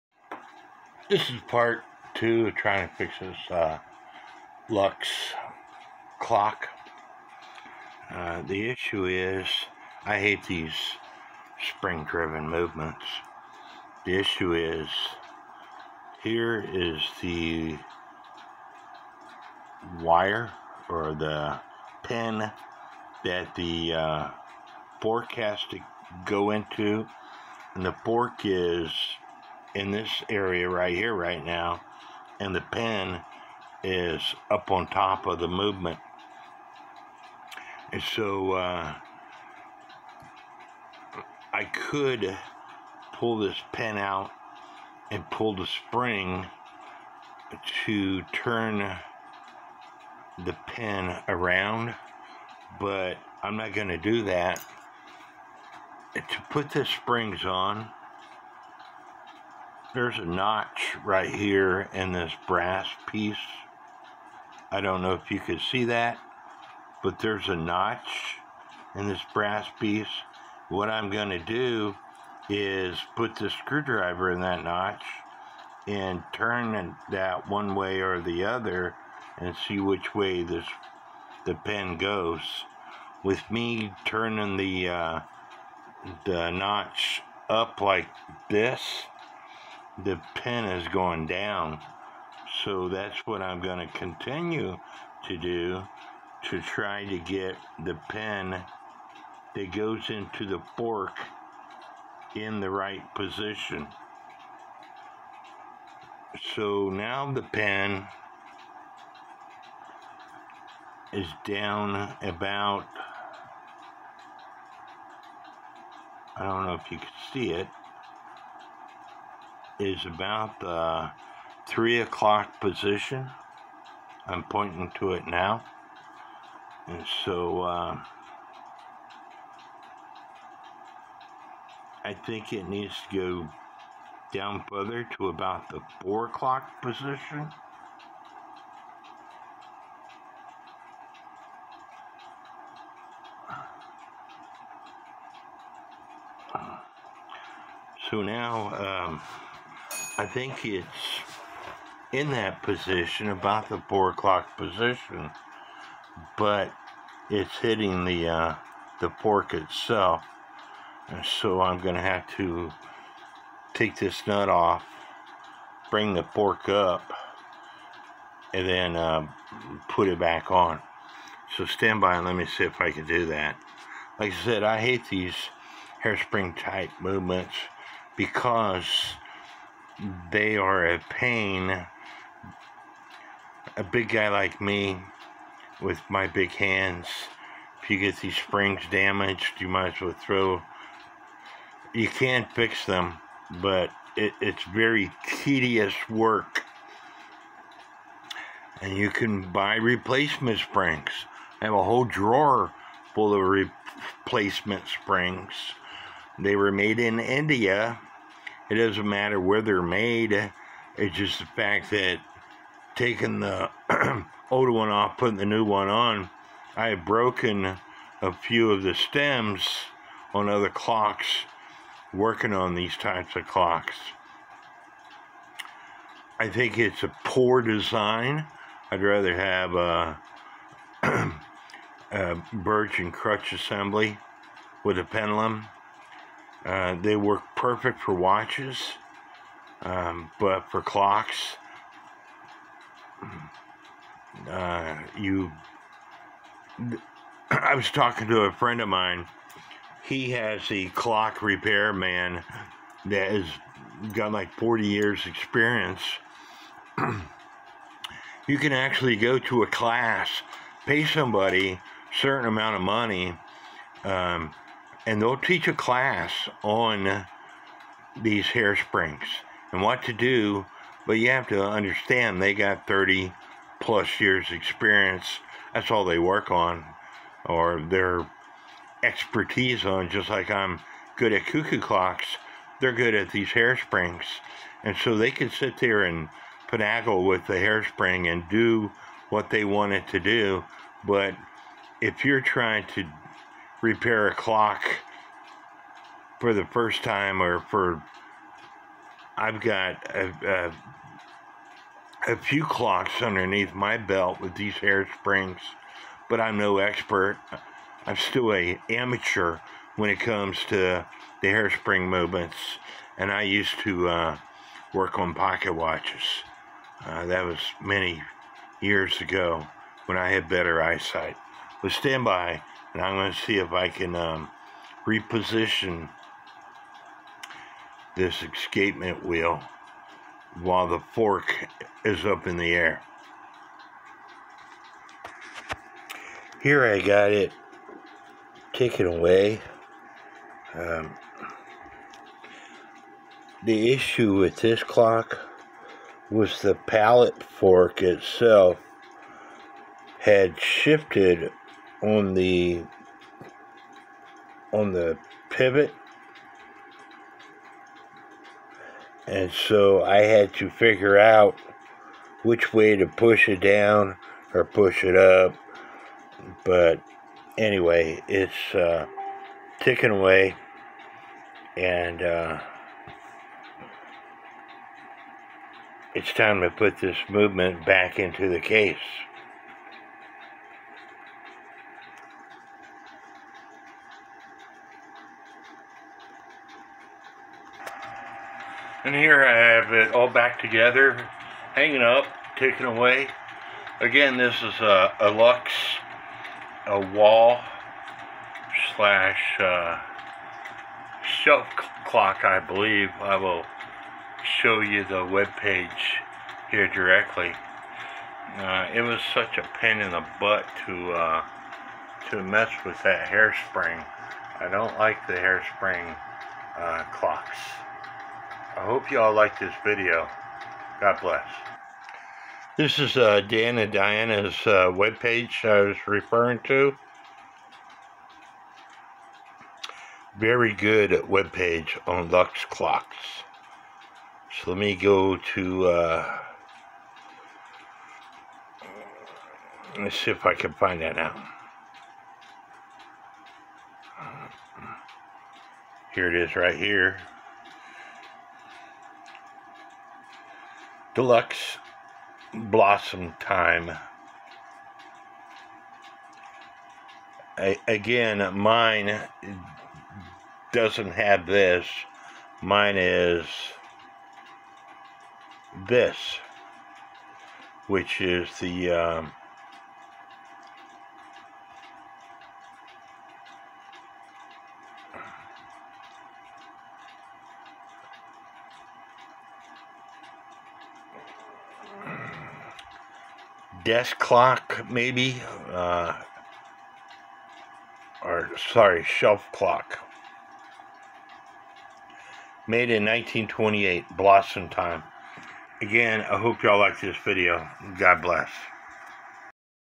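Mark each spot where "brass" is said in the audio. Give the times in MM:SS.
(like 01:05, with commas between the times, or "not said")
01:02, 01:09.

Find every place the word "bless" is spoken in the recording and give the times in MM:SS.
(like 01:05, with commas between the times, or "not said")
07:01, 08:18.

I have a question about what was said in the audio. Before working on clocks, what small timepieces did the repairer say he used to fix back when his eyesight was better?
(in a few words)
pocket watches.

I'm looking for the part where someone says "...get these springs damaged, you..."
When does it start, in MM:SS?
03:07.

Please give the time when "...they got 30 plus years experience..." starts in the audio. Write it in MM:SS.
04:32.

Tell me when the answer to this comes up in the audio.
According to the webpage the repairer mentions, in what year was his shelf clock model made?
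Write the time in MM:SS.
08:13.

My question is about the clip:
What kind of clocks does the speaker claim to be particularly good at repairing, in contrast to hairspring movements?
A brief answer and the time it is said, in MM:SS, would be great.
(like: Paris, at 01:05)
cuckoo clocks, at 04:41.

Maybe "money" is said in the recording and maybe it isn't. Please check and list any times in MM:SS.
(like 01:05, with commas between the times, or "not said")
04:22.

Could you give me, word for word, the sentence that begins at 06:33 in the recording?
Again, this is a, a Lux, a wall slash uh, shelf clock, I believe.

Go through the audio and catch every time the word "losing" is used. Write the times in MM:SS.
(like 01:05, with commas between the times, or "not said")
not said.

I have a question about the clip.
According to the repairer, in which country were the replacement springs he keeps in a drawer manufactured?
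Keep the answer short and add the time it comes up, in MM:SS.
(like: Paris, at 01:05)
India, at 03:27.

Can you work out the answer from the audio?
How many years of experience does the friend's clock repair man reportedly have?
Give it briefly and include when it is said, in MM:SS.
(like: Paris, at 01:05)
40, at 04:14.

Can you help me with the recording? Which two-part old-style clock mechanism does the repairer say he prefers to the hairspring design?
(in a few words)
birch and crutch.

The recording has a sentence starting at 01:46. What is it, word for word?
So now the pen is down about, I don't know if you can see it, is about the uh, three o'clock position.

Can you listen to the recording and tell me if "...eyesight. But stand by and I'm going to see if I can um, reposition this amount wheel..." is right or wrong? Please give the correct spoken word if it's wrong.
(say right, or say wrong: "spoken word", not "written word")
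wrong: "escapement", not "amount".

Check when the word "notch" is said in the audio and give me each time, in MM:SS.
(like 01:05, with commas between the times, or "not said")
01:00, 01:07, 01:14, 01:26.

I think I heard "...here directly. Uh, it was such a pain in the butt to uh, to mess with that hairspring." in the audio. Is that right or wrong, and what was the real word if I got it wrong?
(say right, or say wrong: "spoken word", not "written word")
right.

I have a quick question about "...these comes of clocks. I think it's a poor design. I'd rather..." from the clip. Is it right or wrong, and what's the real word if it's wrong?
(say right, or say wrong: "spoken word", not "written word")
wrong: "types", not "comes".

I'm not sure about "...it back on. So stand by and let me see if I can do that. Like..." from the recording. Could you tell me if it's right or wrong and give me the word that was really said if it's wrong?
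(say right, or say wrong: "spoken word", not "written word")
right.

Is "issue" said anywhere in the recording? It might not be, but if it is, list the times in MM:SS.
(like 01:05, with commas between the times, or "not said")
00:08, 00:14, 05:43.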